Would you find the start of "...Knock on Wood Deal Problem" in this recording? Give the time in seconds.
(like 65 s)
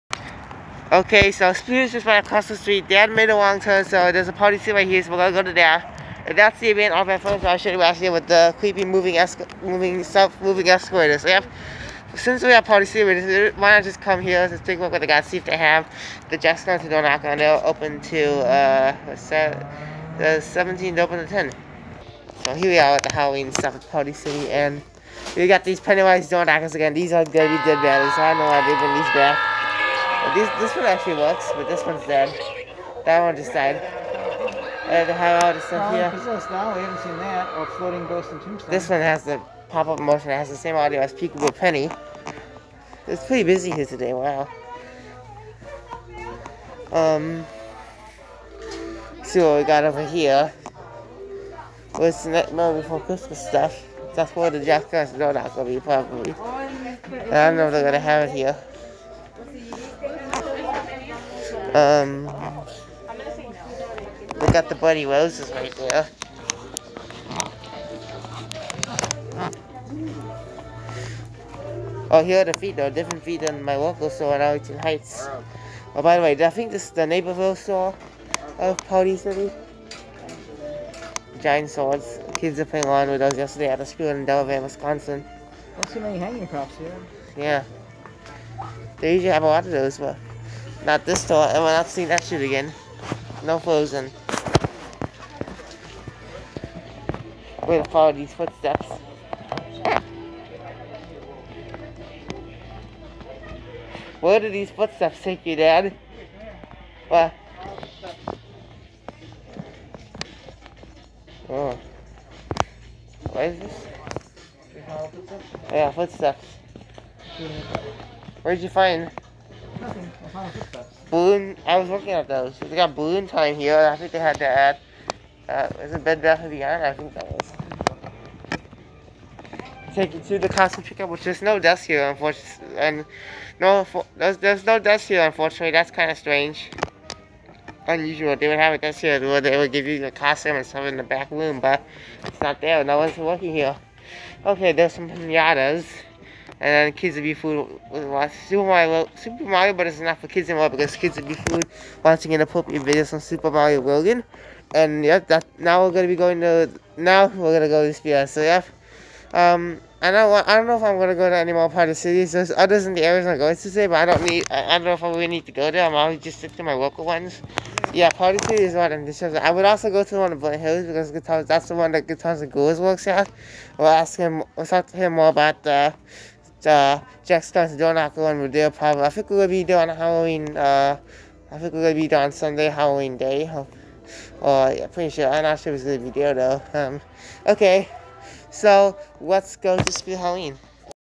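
177 s.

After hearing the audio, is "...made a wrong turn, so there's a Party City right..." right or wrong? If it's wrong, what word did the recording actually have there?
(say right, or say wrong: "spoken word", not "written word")
right.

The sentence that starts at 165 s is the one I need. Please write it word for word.
I'm always just stick to my local ones.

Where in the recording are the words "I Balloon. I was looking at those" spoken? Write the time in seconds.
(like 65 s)
119 s.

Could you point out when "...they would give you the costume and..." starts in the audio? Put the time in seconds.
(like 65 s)
139 s.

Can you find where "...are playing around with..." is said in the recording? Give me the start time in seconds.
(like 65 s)
82 s.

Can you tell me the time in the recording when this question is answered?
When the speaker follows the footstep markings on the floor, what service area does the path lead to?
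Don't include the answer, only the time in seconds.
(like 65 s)
130 s.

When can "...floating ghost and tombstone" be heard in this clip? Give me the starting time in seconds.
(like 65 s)
37 s.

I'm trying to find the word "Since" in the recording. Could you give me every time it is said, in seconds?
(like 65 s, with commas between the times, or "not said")
12 s.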